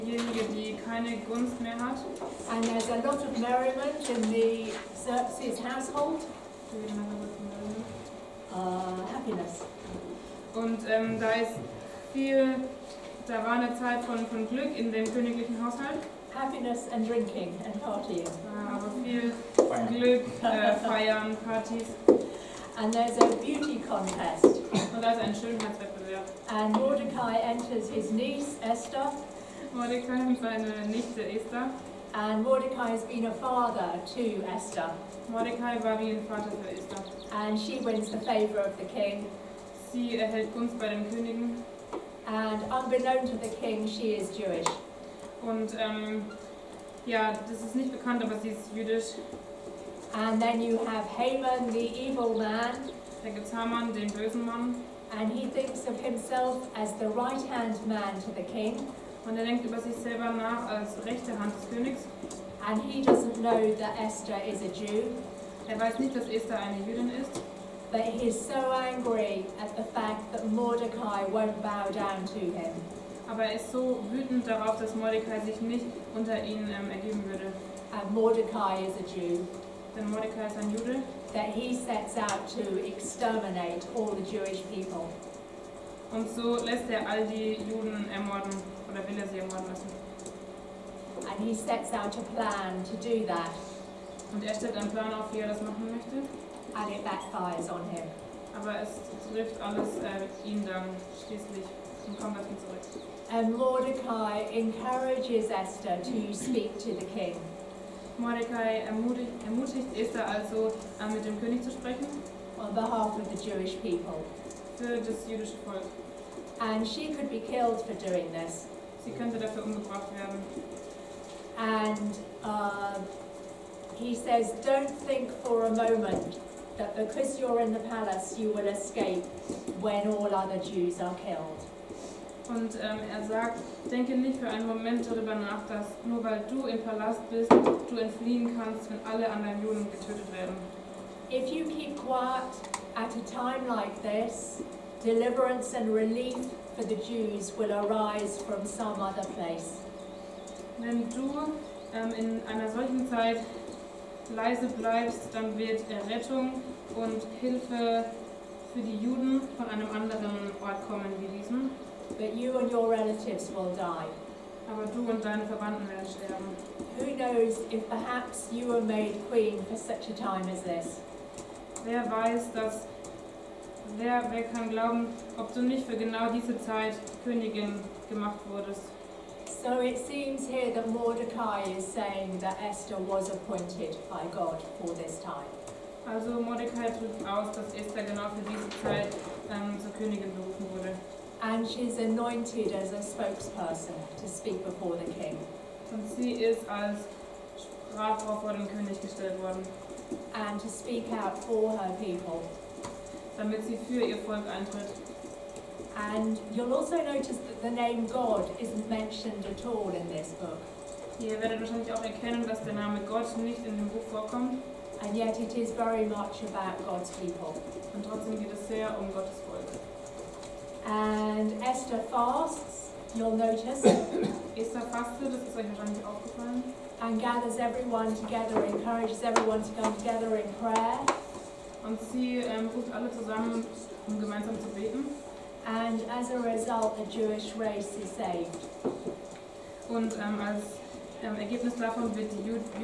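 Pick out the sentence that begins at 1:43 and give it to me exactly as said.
and Mordecai encourages Esther to speak to the king.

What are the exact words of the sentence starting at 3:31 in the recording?
Ihr werdet wahrscheinlich auch erkennen, dass der Name Gott nicht in dem Buch vorkommt.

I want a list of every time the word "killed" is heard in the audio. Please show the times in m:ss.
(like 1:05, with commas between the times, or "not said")
1:57, 2:11.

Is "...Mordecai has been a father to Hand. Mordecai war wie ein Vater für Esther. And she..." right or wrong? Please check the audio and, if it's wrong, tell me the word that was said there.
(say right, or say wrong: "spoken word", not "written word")
wrong: "Esther", not "Hand".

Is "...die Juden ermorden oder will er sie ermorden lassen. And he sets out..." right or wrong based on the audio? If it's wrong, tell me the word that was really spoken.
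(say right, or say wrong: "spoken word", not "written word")
right.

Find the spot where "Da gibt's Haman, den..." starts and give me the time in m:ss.
0:53.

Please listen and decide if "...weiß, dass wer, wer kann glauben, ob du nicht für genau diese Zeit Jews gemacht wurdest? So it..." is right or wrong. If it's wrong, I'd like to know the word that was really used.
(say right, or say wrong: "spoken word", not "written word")
wrong: "Königin", not "Jews".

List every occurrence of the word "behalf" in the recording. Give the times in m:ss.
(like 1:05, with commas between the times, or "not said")
1:52.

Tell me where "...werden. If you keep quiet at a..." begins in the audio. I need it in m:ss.
2:20.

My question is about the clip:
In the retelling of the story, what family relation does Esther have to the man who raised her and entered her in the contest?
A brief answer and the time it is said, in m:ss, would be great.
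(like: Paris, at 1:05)
Niece, at 0:28.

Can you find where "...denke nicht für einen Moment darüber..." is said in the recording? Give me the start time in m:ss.
2:13.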